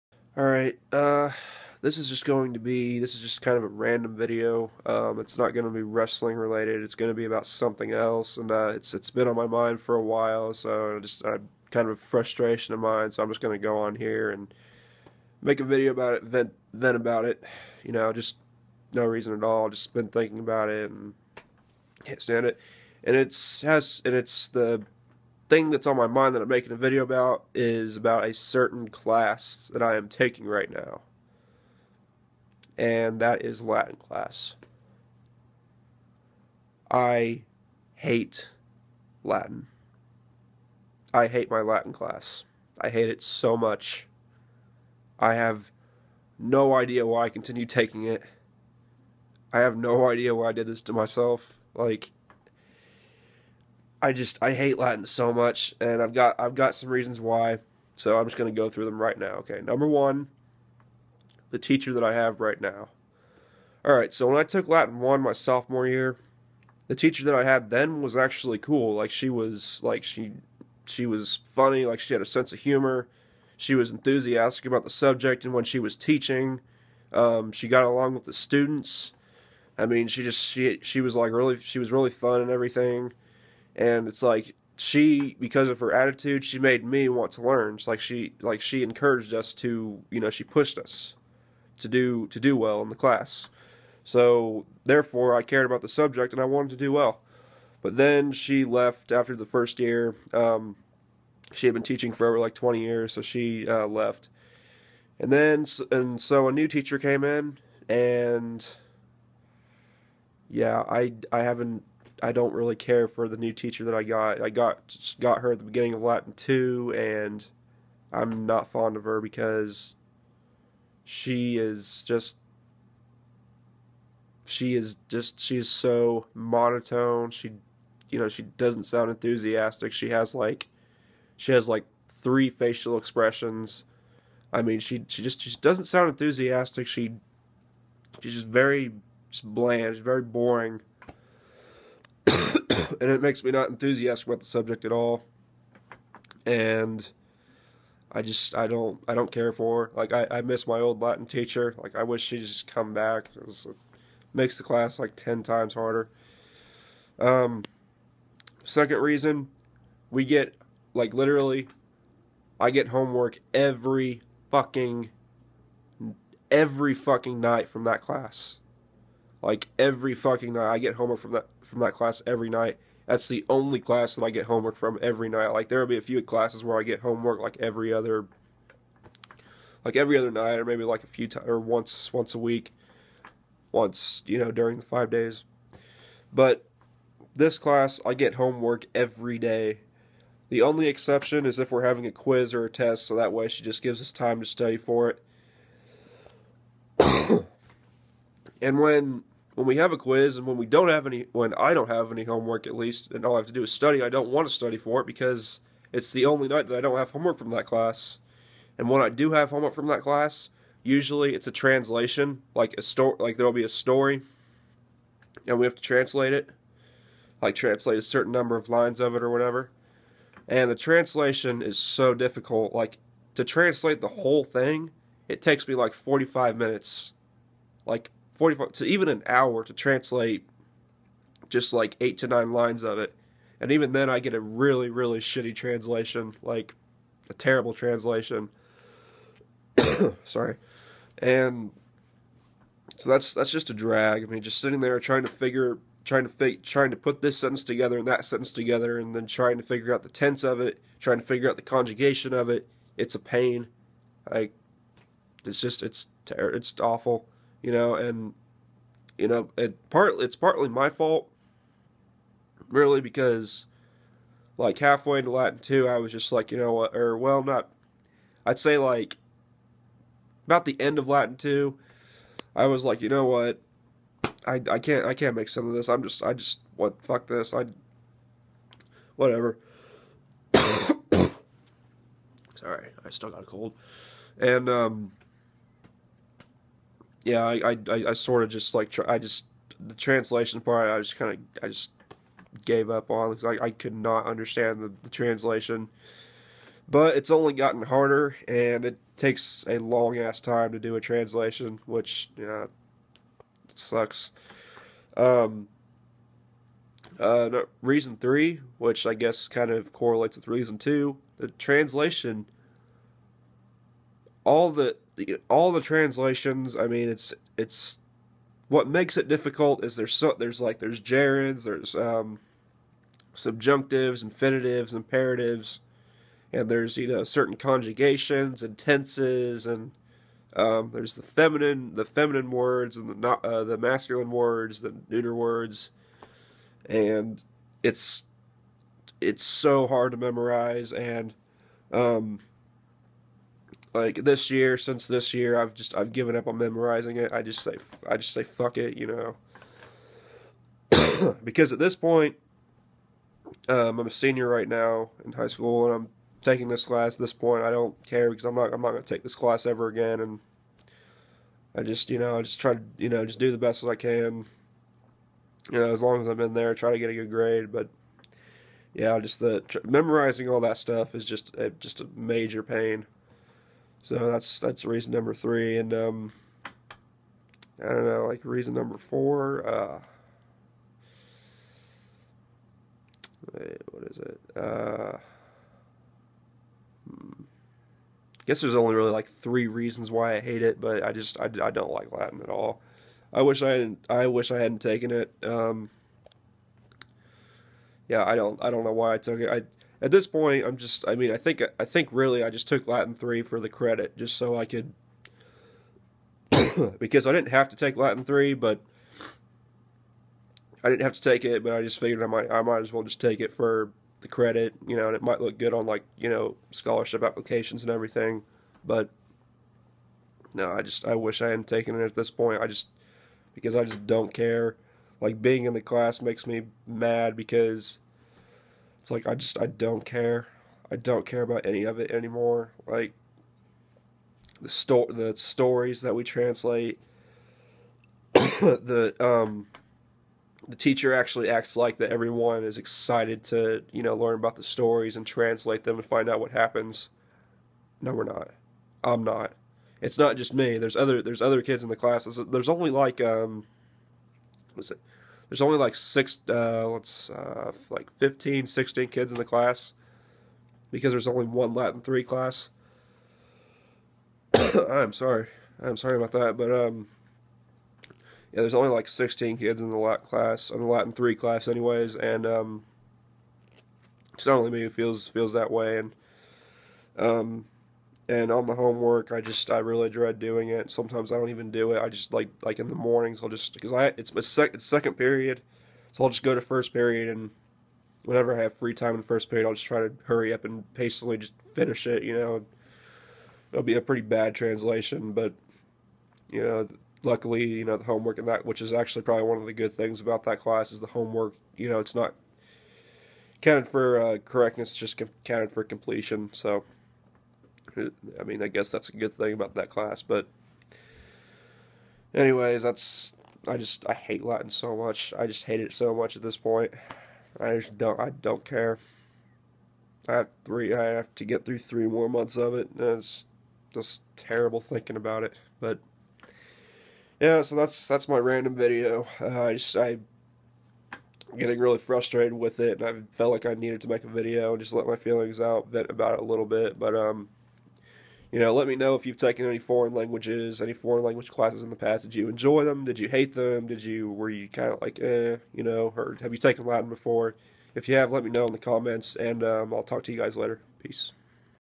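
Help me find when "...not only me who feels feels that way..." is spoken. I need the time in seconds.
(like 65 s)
474 s.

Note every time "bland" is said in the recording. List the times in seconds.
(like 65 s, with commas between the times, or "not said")
139 s.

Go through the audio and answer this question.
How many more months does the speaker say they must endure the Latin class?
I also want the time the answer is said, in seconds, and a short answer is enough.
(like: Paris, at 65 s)
3, at 521 s.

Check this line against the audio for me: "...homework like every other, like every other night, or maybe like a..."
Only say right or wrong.
right.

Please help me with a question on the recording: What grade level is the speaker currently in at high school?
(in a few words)
Senior.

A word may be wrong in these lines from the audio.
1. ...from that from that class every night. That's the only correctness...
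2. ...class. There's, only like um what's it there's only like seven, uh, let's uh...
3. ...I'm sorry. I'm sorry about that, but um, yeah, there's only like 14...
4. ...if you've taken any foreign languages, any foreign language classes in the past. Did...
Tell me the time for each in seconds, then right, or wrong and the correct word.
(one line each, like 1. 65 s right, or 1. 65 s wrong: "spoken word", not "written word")
1. 171 s wrong: "class", not "correctness"
2. 451 s wrong: "six", not "seven"
3. 464 s wrong: "16", not "14"
4. 539 s right.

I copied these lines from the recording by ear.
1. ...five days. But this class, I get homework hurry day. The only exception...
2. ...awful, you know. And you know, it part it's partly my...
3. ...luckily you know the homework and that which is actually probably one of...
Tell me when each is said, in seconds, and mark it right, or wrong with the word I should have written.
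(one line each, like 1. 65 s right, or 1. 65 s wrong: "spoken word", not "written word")
1. 184 s wrong: "every", not "hurry"
2. 256 s right
3. 497 s right.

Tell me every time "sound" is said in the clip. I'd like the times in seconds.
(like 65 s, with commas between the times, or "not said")
128 s, 135 s.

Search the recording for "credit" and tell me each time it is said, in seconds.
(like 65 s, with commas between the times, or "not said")
403 s, 414 s.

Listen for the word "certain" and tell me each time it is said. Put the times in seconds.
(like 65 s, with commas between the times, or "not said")
28 s, 218 s, 327 s.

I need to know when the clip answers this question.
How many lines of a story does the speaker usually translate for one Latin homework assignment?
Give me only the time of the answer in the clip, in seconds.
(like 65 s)
232 s.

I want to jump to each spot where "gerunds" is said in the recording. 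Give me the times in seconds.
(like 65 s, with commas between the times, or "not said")
321 s.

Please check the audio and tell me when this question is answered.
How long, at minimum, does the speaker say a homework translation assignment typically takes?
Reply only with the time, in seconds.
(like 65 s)
225 s.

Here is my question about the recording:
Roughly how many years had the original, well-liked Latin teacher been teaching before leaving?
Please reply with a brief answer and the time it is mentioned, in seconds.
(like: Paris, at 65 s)
Over 20 years, at 102 s.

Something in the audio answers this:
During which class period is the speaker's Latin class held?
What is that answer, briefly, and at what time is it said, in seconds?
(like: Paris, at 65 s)
Second period, at 484 s.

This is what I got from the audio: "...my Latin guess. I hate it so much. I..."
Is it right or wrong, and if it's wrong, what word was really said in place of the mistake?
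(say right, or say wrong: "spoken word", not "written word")
wrong: "class", not "guess".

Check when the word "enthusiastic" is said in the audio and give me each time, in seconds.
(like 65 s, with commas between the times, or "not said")
73 s, 129 s, 136 s, 143 s.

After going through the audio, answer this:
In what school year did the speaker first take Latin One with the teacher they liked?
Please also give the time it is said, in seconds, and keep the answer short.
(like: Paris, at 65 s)
Sophomore year, at 65 s.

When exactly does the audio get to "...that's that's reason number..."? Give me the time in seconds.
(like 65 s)
374 s.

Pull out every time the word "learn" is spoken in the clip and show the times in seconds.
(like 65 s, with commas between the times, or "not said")
87 s, 444 s.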